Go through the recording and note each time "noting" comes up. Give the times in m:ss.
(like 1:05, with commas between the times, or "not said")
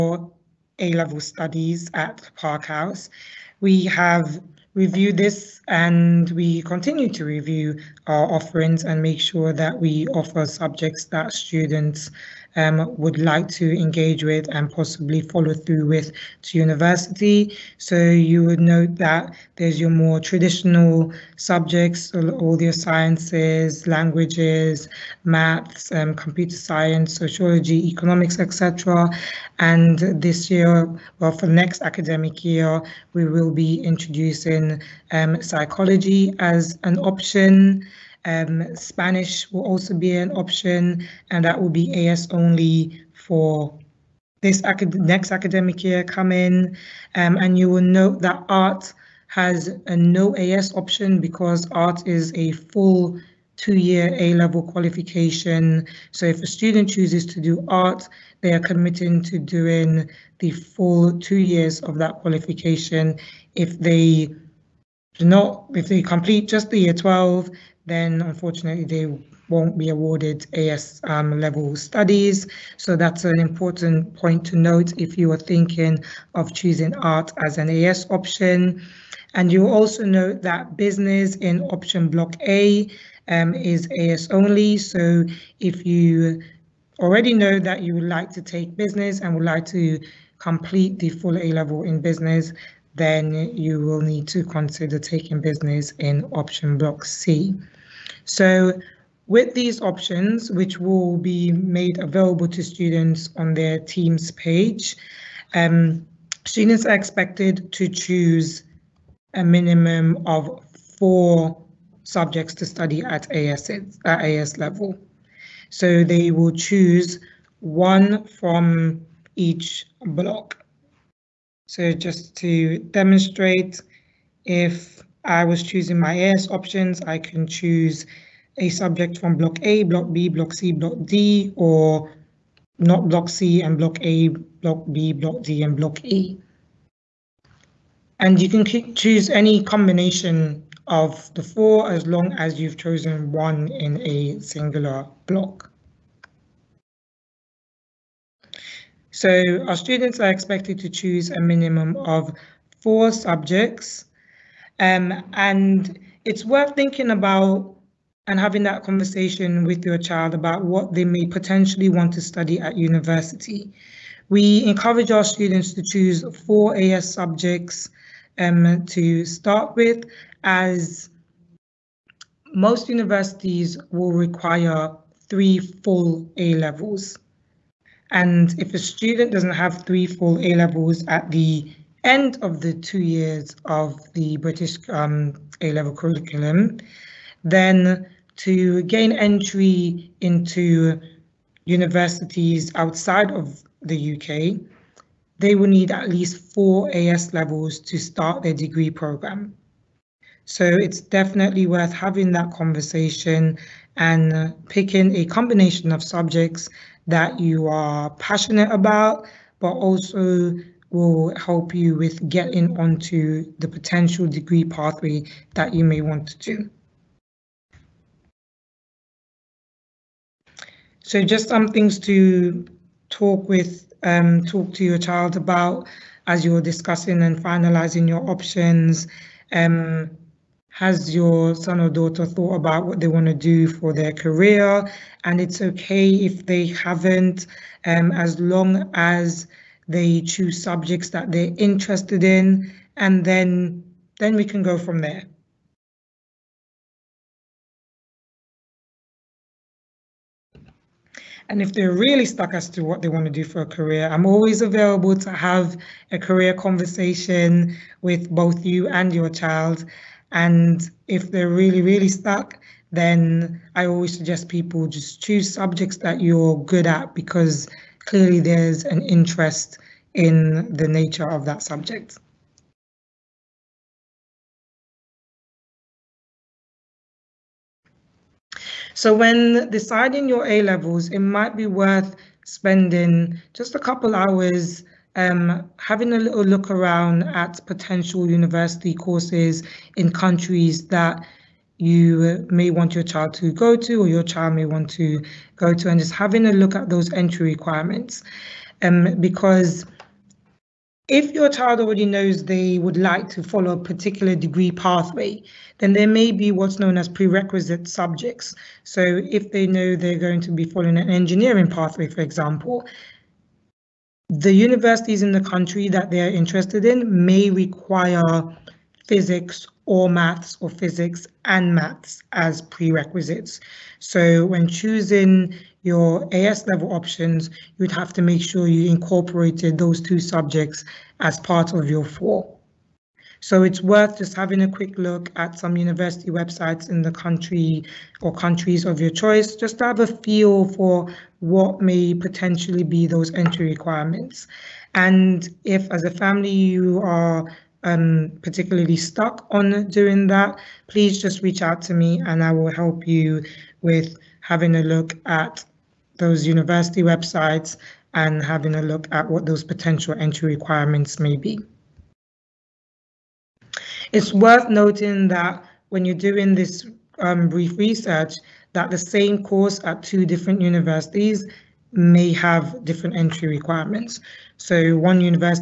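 6:04.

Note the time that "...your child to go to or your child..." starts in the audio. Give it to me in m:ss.
4:52.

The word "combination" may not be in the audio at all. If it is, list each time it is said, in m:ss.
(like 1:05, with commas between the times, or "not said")
2:19, 3:25.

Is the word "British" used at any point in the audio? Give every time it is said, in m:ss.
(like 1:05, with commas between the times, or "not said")
3:04.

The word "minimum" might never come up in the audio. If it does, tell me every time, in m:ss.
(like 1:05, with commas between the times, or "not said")
1:49, 2:31.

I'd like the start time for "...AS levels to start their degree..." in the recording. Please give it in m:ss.
3:16.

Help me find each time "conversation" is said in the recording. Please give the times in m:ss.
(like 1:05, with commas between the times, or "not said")
2:38, 3:22, 4:16.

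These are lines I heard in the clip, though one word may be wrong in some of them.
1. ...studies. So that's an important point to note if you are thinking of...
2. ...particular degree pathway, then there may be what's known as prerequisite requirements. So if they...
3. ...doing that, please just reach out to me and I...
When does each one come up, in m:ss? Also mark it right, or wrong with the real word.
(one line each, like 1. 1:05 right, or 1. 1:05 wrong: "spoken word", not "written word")
1. 1:11 right
2. 5:03 wrong: "subjects", not "requirements"
3. 5:49 right.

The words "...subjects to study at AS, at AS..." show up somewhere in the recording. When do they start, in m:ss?
1:52.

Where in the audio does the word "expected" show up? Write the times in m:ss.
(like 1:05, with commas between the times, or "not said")
1:46, 2:30.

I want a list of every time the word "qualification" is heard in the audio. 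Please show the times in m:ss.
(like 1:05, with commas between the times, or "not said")
0:54, 1:02.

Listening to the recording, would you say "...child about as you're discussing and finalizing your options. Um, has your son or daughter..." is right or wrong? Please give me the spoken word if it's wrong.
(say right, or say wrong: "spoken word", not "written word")
right.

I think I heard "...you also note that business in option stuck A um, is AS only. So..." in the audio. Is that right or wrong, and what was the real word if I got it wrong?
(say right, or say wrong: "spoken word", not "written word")
wrong: "block", not "stuck".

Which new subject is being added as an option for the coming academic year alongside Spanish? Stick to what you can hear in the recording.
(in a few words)
psychology.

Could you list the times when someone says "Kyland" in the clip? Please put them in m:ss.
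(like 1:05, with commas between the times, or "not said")
not said.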